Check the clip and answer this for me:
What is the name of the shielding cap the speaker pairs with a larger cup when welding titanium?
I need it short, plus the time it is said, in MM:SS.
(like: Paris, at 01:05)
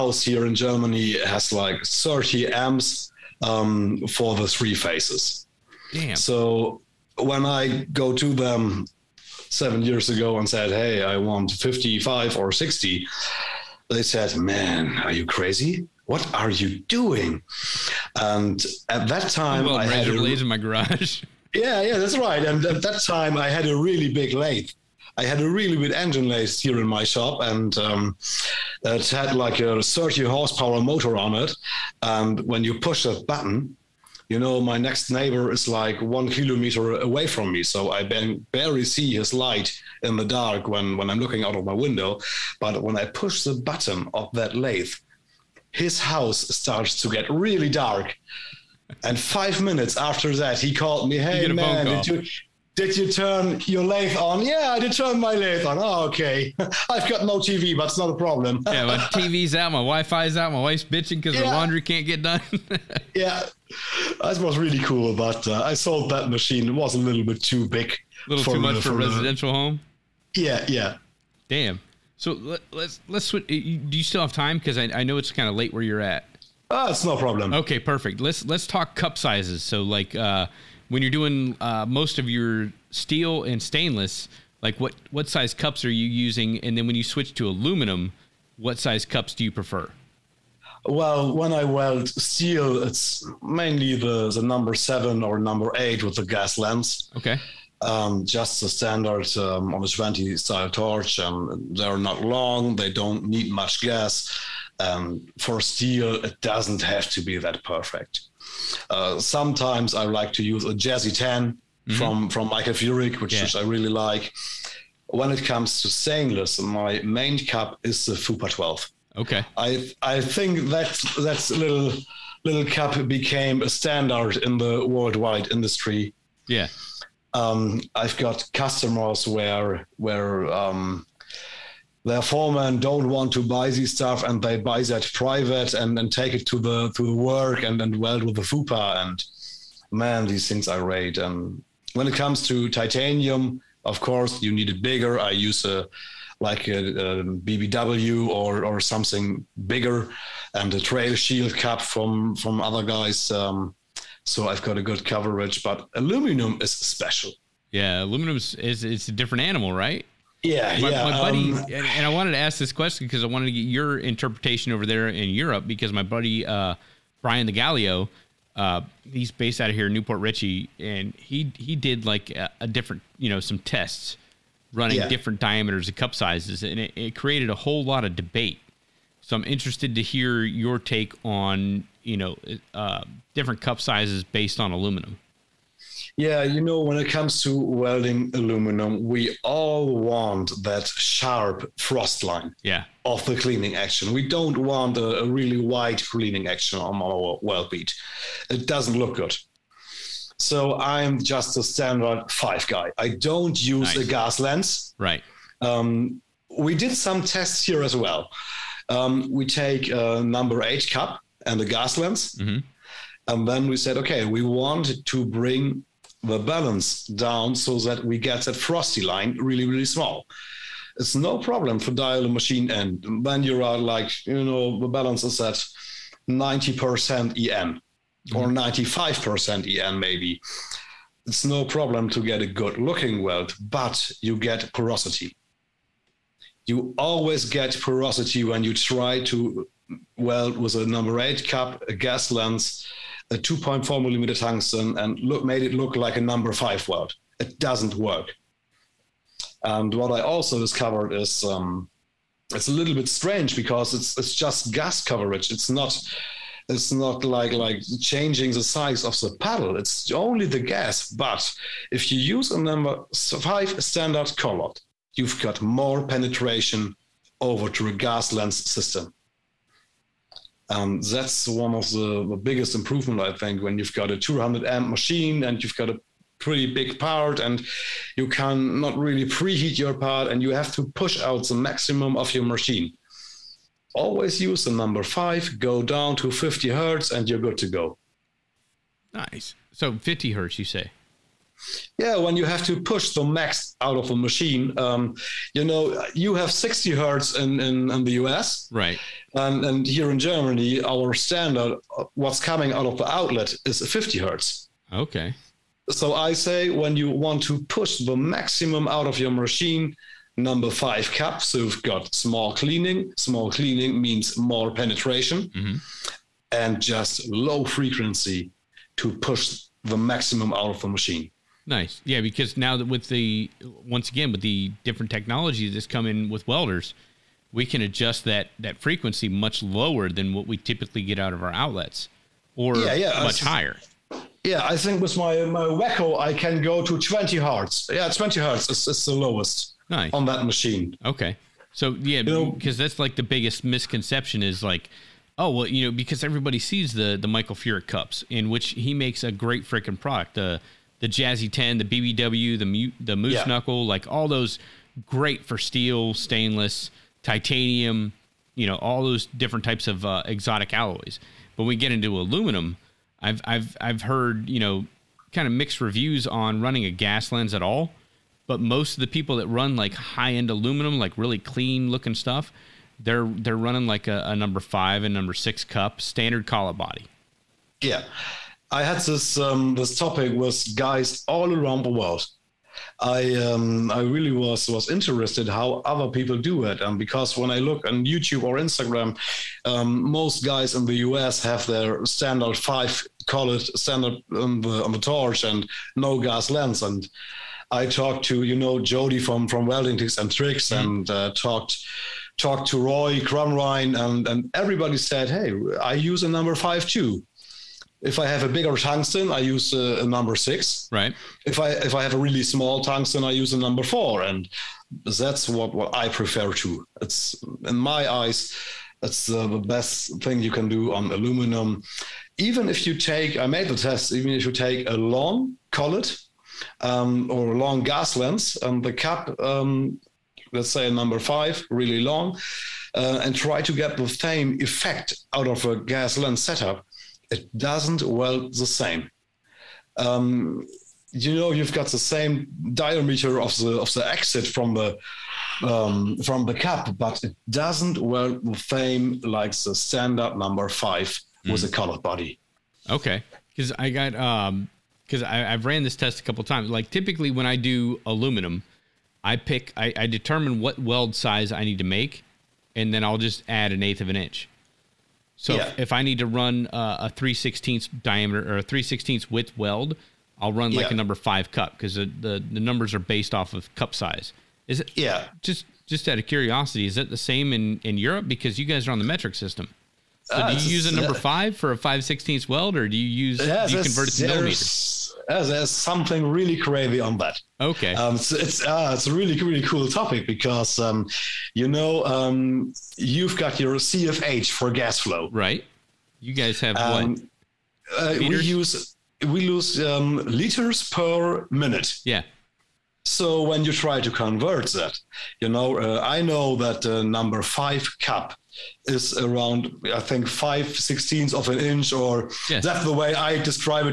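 Trail Shield, at 02:30.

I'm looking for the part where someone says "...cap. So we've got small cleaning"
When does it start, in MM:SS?
05:11.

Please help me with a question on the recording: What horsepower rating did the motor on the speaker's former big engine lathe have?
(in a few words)
30.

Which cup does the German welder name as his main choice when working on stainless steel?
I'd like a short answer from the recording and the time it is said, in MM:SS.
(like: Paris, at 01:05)
Fupa 12, at 01:58.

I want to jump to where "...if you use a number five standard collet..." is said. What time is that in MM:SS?
04:21.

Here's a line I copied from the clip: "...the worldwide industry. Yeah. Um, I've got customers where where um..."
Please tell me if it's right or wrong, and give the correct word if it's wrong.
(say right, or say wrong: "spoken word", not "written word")
right.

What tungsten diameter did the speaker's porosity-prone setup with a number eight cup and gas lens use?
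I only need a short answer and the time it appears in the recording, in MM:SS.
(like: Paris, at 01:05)
2.4 millimeters, at 04:03.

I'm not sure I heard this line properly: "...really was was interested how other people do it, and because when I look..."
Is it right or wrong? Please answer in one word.
right.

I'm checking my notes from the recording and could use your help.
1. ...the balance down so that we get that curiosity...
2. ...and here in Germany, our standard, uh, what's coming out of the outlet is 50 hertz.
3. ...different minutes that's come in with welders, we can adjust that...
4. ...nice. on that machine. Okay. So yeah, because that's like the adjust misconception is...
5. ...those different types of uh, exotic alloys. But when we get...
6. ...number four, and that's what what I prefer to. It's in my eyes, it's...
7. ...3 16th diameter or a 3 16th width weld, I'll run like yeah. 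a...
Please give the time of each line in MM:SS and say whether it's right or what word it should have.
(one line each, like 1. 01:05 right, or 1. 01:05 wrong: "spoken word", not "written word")
1. 03:36 wrong: "frosty", not "curiosity"
2. 04:59 right
3. 05:24 wrong: "technologies", not "minutes"
4. 05:39 wrong: "biggest", not "adjust"
5. 05:59 right
6. 06:53 right
7. 07:47 right.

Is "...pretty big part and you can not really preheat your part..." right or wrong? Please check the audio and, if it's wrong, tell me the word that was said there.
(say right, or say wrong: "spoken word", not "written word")
right.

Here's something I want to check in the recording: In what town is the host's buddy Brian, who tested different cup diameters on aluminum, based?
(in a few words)
Newport Richey.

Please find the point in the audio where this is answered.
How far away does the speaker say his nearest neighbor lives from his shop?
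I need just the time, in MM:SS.
00:35.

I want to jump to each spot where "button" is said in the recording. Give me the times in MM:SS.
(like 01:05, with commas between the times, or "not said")
00:33, 00:43.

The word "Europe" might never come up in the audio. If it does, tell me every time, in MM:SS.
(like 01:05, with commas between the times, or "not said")
02:45, 07:57.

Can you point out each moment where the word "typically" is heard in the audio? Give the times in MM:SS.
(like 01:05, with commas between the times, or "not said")
05:30, 07:36.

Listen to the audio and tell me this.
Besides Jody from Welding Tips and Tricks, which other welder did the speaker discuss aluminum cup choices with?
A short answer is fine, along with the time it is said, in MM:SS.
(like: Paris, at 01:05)
Roy Crumrine, at 06:42.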